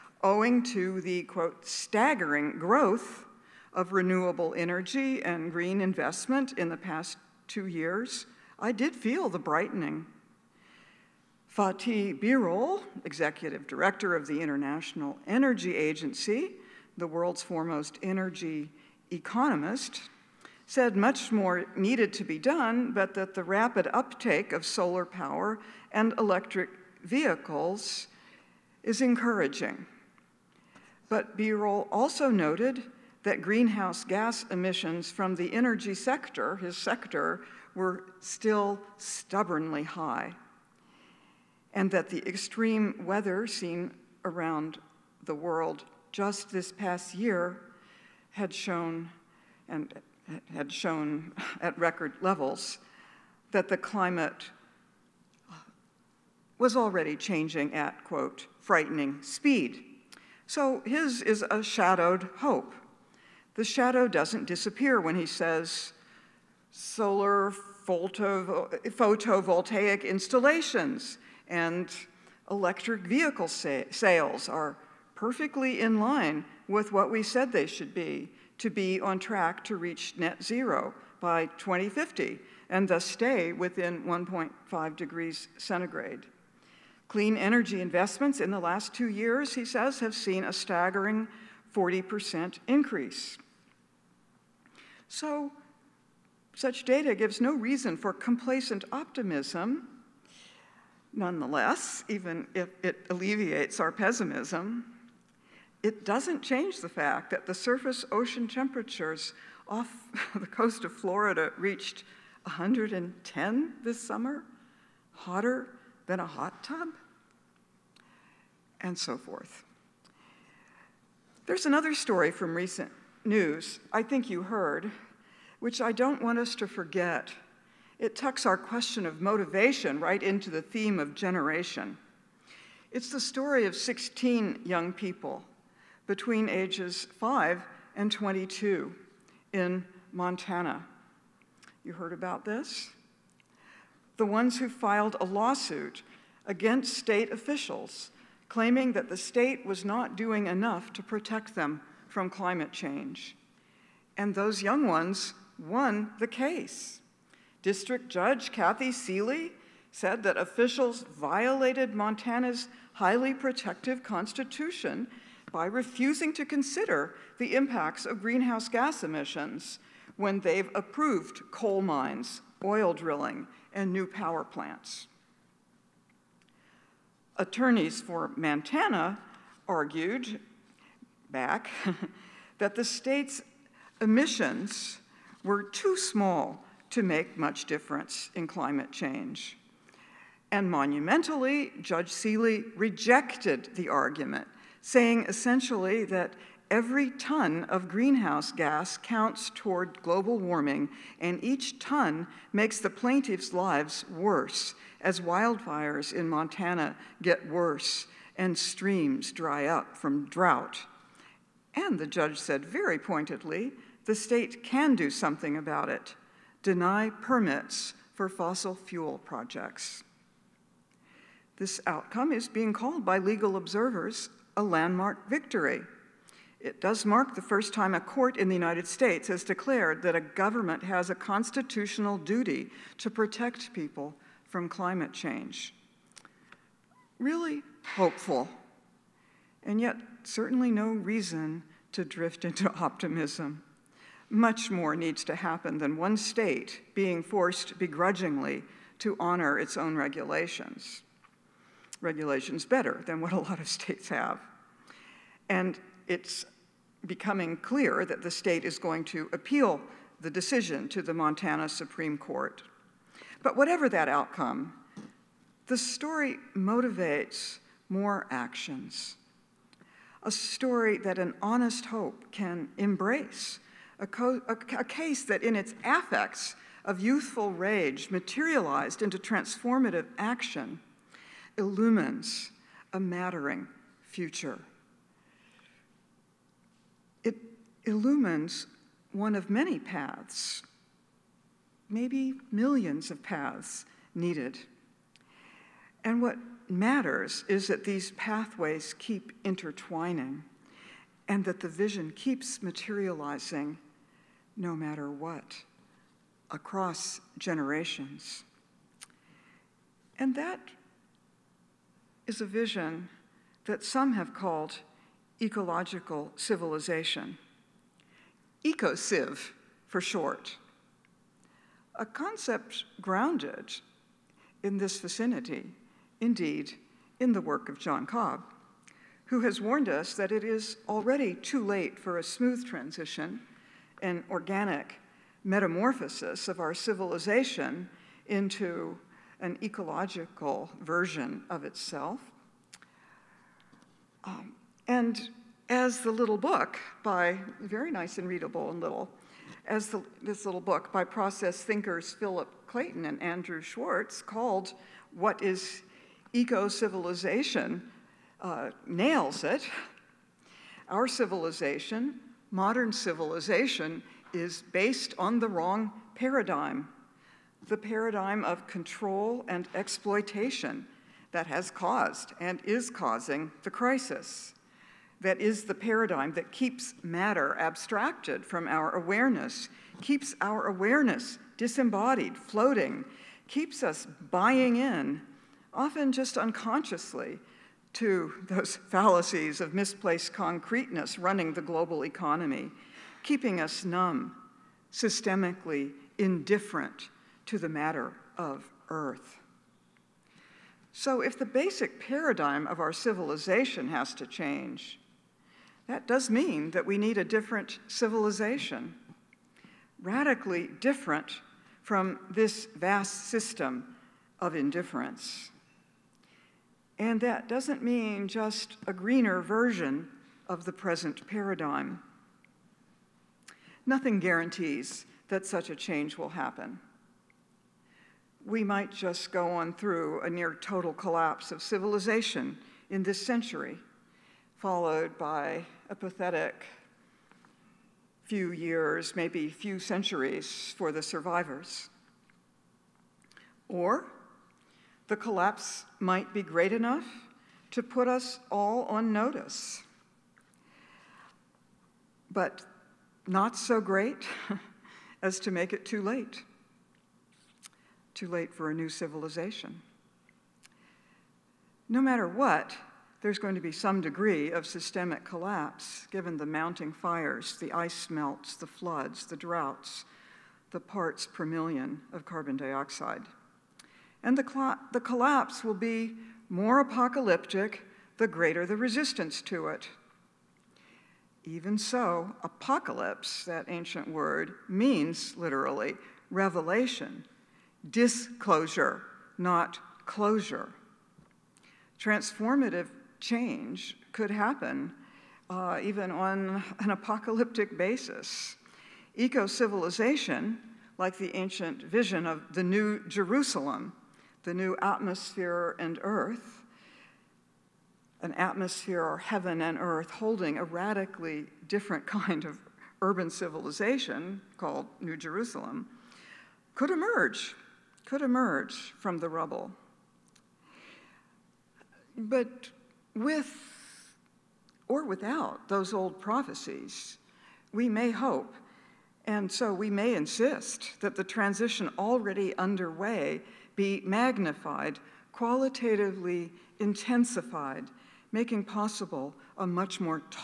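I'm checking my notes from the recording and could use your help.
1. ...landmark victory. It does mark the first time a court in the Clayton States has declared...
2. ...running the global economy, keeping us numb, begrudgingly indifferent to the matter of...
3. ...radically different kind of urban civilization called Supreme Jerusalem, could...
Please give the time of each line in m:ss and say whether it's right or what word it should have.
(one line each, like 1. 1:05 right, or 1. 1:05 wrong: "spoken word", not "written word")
1. 3:44 wrong: "United", not "Clayton"
2. 6:31 wrong: "systemically", not "begrudgingly"
3. 8:30 wrong: "New", not "Supreme".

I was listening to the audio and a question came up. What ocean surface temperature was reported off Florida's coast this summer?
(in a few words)
110.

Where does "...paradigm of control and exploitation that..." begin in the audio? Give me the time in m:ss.
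6:07.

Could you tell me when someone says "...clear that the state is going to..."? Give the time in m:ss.
4:17.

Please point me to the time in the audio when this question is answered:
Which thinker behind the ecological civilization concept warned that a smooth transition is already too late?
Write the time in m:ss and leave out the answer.
5:27.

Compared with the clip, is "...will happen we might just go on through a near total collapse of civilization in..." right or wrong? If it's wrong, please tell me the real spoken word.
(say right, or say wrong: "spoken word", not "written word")
right.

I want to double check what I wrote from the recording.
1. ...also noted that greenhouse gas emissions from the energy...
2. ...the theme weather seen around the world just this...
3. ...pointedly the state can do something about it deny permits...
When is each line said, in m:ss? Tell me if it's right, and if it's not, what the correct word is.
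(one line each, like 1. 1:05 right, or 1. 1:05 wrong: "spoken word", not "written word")
1. 0:31 right
2. 0:42 wrong: "extreme", not "theme"
3. 3:32 right.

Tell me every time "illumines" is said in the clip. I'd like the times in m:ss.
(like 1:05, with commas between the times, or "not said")
4:41, 4:47.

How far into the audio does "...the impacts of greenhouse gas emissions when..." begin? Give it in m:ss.
2:47.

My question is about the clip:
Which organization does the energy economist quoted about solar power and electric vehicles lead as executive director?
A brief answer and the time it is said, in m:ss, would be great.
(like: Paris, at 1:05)
International Energy Agency, at 0:14.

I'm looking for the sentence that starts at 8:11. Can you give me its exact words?
Transformative change could happen uh, even on an apocalyptic basis.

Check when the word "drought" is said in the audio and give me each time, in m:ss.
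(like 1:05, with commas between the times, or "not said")
3:30, 7:49.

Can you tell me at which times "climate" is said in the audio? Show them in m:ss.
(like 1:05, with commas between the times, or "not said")
0:53, 2:32, 3:08, 3:54.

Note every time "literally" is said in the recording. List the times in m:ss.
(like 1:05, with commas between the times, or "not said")
8:05.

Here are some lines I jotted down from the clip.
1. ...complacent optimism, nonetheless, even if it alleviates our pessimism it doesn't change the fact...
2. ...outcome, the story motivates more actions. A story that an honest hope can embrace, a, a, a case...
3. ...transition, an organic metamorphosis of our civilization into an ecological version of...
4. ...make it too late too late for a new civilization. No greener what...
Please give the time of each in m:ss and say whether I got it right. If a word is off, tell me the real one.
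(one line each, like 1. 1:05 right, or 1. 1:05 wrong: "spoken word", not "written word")
1. 1:38 right
2. 4:24 right
3. 5:32 right
4. 7:35 wrong: "matter", not "greener".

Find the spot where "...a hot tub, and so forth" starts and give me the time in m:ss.
1:56.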